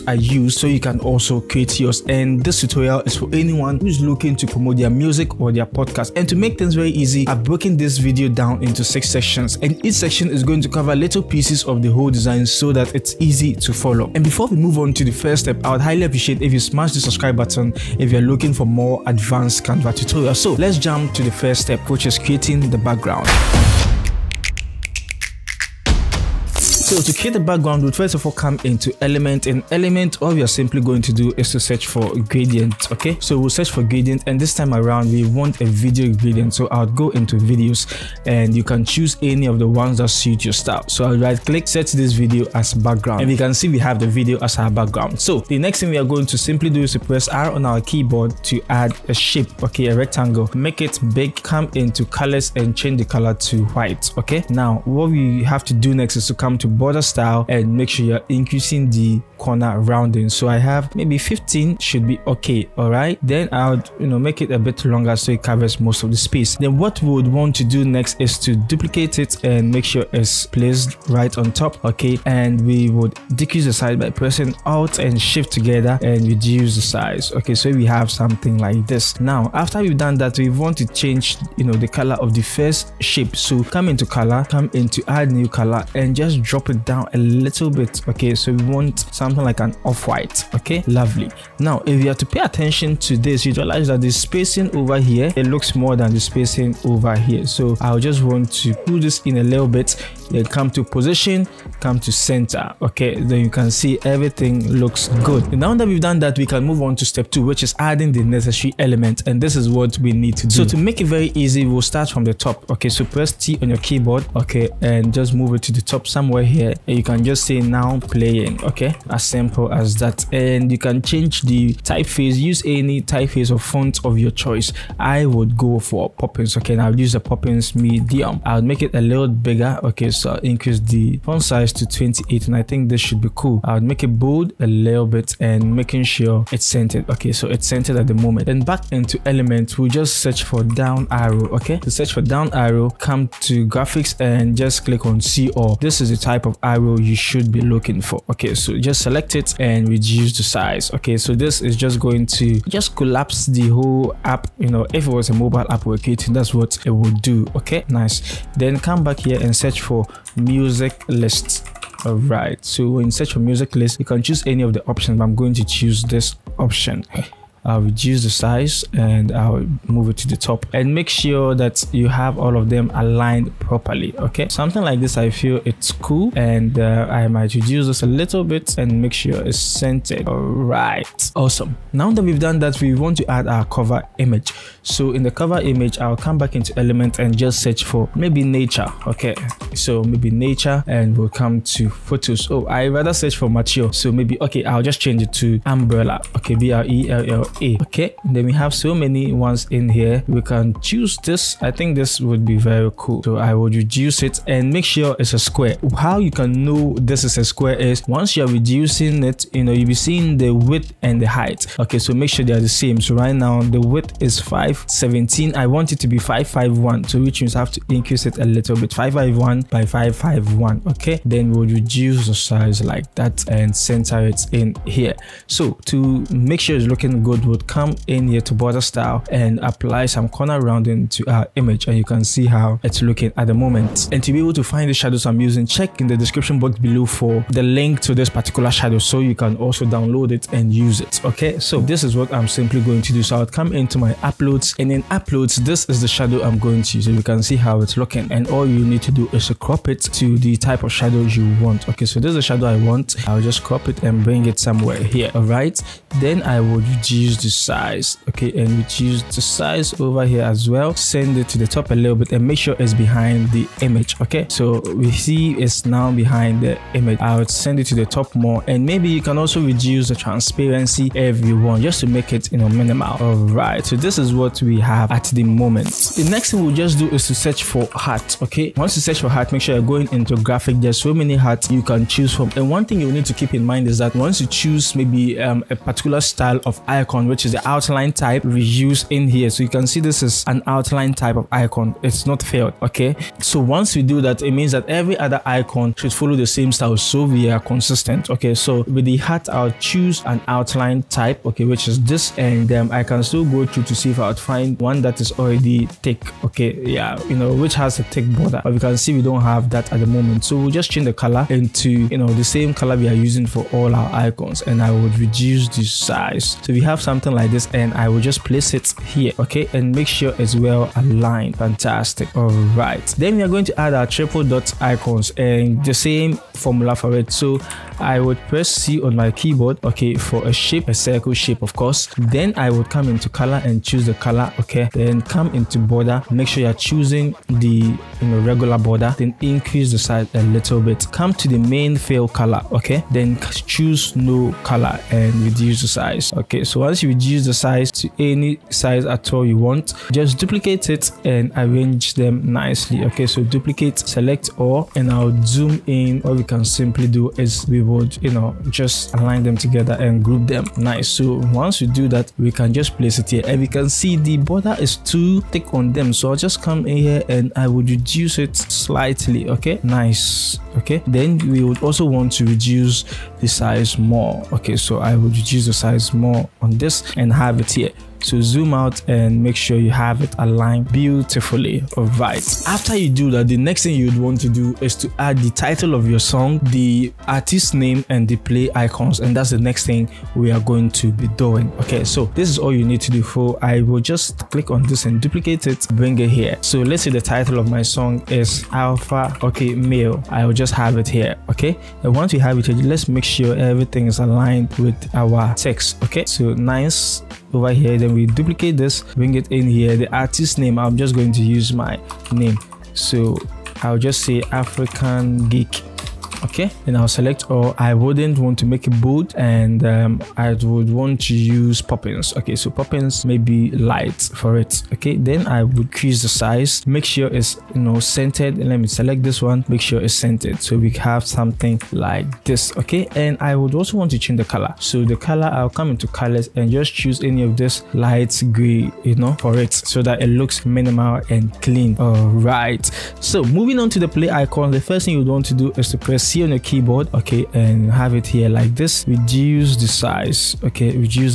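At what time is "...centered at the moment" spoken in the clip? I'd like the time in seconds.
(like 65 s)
137 s.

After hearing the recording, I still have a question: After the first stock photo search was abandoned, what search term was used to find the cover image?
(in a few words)
umbrella.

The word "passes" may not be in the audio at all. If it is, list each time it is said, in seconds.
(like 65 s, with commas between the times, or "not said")
not said.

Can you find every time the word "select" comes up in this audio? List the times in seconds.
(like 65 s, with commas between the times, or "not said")
149 s, 353 s, 417 s, 428 s.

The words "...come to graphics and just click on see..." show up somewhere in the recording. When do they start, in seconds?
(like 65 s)
142 s.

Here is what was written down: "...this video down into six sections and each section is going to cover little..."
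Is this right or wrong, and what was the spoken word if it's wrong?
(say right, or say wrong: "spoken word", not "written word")
right.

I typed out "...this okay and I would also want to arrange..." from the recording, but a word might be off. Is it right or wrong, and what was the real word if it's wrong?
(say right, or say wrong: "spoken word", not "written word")
wrong: "change", not "arrange".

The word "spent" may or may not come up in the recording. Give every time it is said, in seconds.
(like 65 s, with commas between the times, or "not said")
not said.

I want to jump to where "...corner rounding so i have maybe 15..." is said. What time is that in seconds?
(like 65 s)
59 s.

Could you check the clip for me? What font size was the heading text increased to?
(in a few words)
28.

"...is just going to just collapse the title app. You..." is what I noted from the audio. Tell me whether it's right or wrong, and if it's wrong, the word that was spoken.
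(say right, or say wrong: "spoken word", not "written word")
wrong: "whole", not "title".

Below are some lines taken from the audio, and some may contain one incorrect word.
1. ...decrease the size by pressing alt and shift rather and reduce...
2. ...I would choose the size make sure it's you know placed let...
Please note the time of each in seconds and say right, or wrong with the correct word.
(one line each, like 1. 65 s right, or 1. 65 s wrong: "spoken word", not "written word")
1. 73 s wrong: "together", not "rather"
2. 425 s wrong: "centered", not "placed".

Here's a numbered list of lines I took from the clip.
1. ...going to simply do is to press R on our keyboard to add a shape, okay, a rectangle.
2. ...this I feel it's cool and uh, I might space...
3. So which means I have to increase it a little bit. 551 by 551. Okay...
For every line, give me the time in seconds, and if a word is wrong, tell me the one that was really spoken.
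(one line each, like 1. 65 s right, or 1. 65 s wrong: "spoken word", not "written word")
1. 46 s right
2. 174 s wrong: "reduce", not "space"
3. 217 s right.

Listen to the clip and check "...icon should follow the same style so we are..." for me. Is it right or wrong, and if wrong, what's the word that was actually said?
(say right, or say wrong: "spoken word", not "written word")
right.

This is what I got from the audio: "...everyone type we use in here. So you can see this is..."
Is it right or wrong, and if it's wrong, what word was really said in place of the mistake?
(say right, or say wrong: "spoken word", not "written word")
wrong: "outline", not "everyone".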